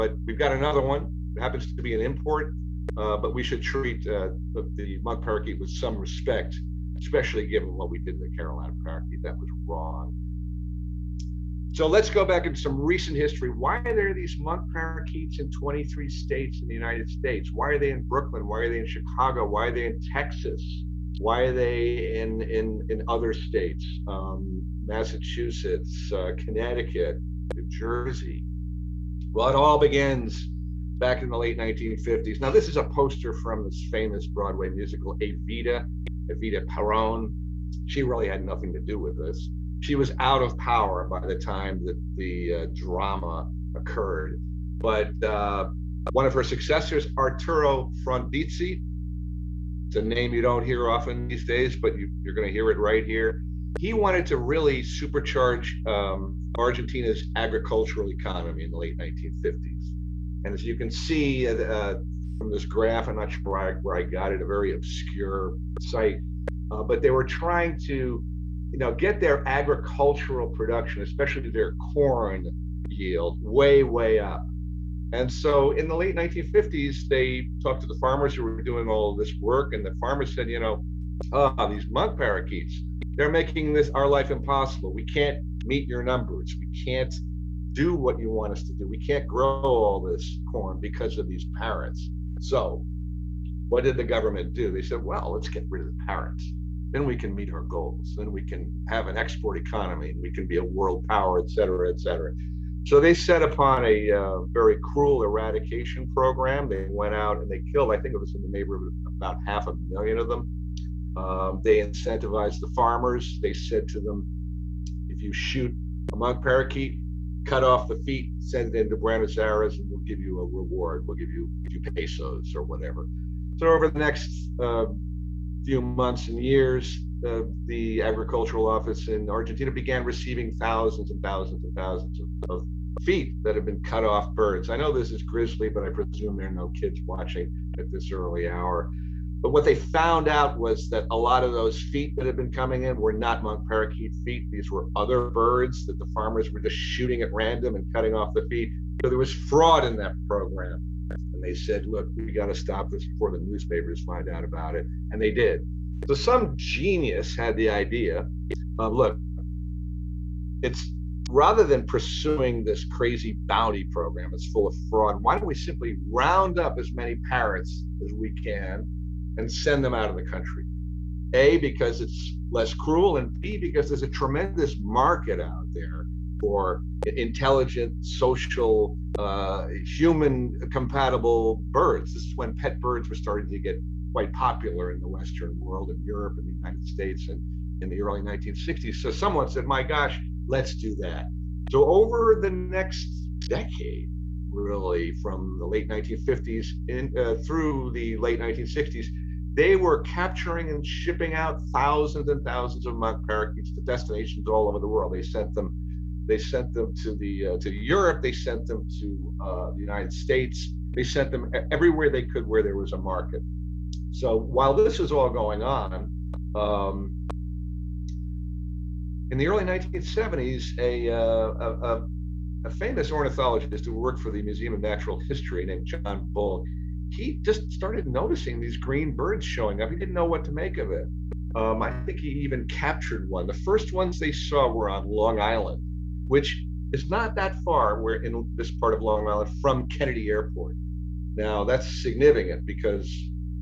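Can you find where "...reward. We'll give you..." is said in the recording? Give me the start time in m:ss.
2:00.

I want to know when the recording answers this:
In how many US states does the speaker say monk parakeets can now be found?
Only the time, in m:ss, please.
0:15.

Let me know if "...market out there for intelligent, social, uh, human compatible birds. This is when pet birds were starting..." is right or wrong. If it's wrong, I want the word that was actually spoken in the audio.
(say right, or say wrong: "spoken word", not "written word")
right.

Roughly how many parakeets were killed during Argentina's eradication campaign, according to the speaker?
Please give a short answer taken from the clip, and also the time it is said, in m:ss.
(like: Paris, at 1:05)
Half a million, at 1:49.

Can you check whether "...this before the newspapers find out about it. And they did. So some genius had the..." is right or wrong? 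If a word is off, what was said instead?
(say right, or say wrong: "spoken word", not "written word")
right.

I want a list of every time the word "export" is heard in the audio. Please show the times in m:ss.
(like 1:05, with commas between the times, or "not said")
1:39.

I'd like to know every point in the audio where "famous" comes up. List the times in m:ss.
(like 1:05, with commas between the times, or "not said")
0:33, 3:42.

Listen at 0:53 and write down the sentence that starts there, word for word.
He wanted to really supercharge um, Argentina's agricultural economy in the late 1950s.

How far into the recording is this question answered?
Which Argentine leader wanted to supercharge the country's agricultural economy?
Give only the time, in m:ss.
0:47.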